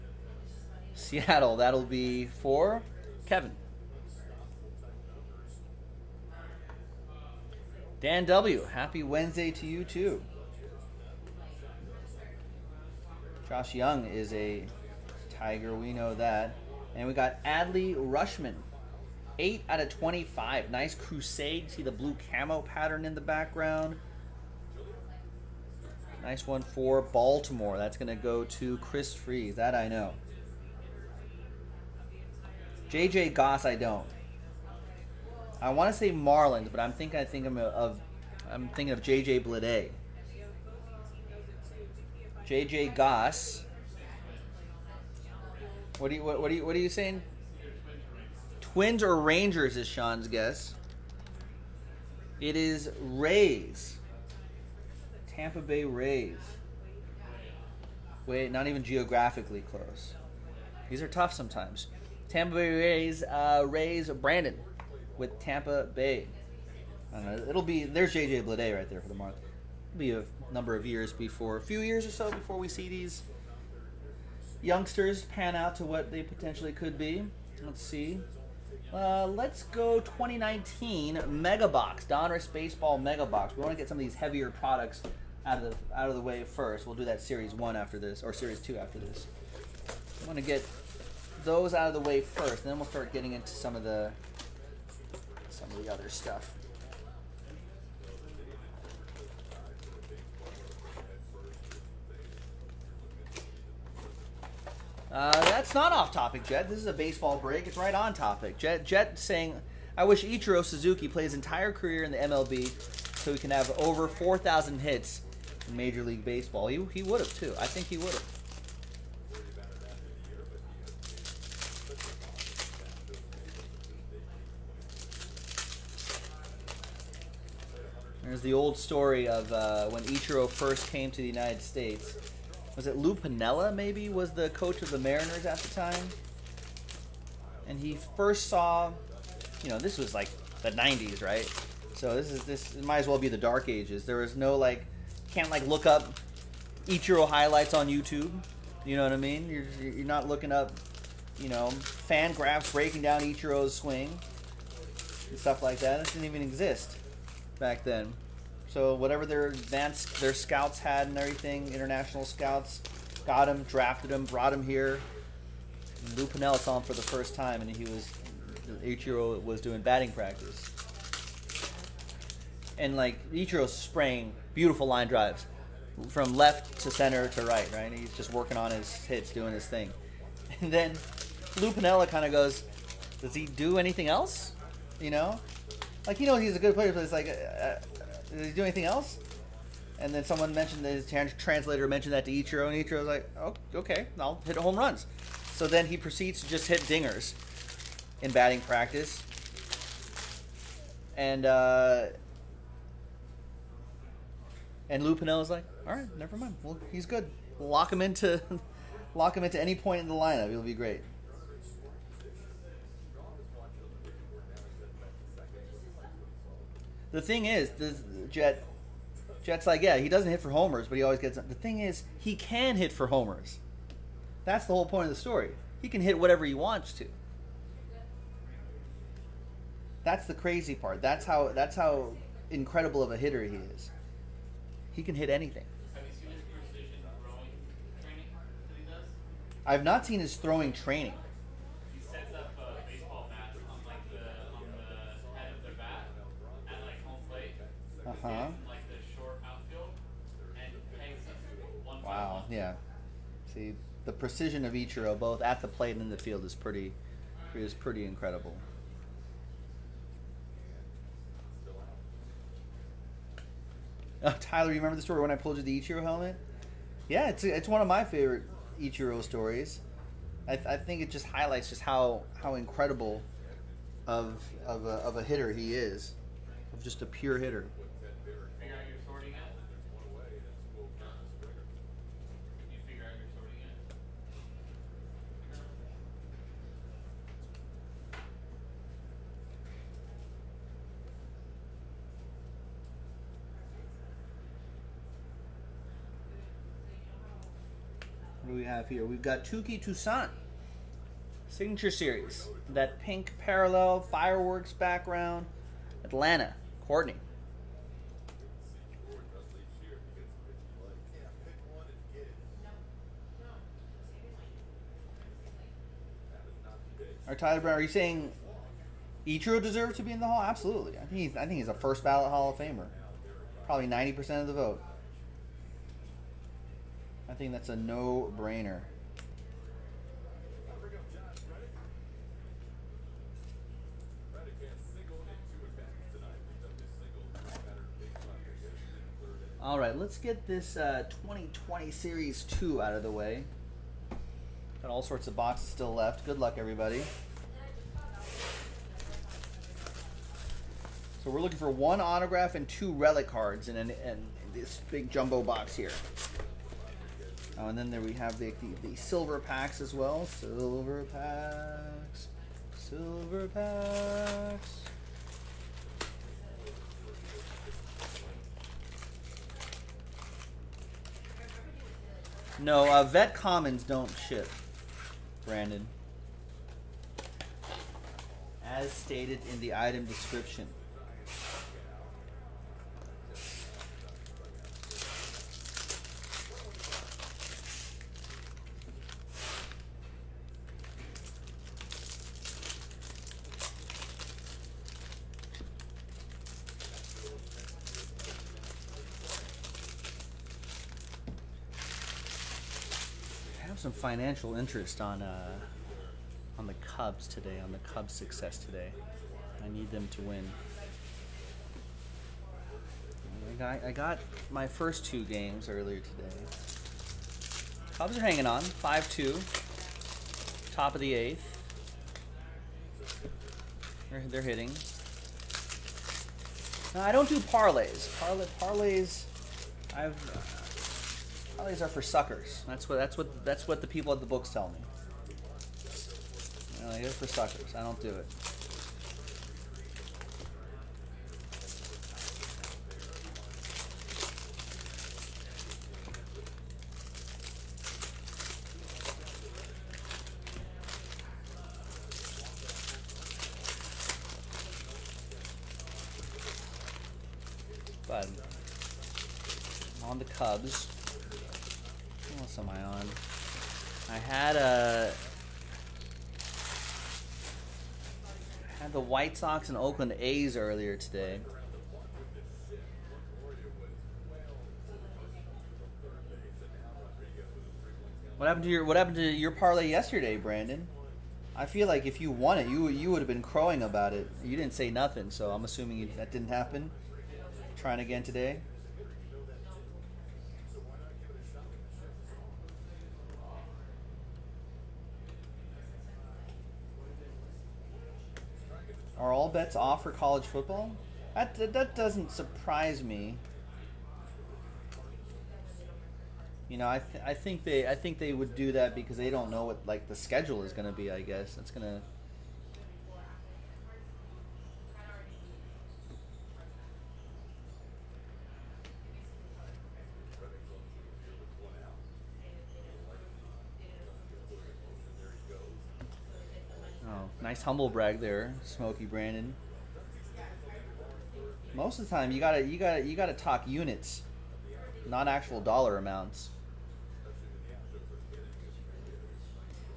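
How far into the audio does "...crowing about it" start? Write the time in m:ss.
8:03.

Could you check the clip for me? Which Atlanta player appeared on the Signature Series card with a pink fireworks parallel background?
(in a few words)
Touki Toussaint.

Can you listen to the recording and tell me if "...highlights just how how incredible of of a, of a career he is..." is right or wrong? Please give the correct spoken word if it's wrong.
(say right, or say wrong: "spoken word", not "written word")
wrong: "hitter", not "career".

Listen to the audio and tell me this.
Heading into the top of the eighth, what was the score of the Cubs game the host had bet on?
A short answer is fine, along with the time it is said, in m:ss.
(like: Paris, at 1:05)
5-2, at 6:58.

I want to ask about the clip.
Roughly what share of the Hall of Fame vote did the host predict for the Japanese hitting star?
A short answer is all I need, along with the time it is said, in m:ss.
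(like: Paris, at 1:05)
90%, at 5:23.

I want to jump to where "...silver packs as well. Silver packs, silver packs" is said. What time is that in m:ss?
5:58.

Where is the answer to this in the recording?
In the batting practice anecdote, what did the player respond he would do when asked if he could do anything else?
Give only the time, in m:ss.
3:14.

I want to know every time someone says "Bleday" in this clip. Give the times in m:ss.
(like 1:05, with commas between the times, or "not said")
0:39, 1:08.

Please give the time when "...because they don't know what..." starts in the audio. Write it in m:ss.
8:28.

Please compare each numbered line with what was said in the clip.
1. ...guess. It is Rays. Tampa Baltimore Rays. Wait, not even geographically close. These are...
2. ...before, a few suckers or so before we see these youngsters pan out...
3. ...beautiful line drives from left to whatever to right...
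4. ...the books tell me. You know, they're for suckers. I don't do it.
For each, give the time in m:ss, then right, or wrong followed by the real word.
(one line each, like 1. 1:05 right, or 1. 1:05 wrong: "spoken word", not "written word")
1. 0:50 wrong: "Bay", not "Baltimore"
2. 1:11 wrong: "years", not "suckers"
3. 2:54 wrong: "center", not "whatever"
4. 7:14 right.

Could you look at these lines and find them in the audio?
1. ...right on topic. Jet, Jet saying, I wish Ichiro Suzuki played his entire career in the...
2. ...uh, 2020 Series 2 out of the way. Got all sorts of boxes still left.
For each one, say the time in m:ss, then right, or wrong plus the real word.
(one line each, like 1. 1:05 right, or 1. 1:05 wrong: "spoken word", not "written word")
1. 1:47 right
2. 5:40 right.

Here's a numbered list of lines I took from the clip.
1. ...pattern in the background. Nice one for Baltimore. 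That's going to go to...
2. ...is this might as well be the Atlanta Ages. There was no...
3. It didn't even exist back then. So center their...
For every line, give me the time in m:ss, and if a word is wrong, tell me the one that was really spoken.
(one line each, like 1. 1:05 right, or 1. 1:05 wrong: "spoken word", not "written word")
1. 0:22 right
2. 2:22 wrong: "Dark", not "Atlanta"
3. 2:35 wrong: "whatever", not "center".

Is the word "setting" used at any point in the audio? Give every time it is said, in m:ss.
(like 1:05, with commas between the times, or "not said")
not said.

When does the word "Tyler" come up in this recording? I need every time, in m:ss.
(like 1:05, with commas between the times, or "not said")
4:24, 5:17.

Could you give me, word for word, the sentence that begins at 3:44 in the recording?
That's the whole point of the story.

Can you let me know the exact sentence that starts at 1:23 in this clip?
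We want to get some of these heavier products out of the out of the way first.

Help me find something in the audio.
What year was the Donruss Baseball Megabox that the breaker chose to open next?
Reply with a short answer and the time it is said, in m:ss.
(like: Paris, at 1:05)
2019, at 1:19.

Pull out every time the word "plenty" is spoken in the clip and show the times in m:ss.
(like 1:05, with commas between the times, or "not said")
not said.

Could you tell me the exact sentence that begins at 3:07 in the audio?
Uh, uh did he do anything else?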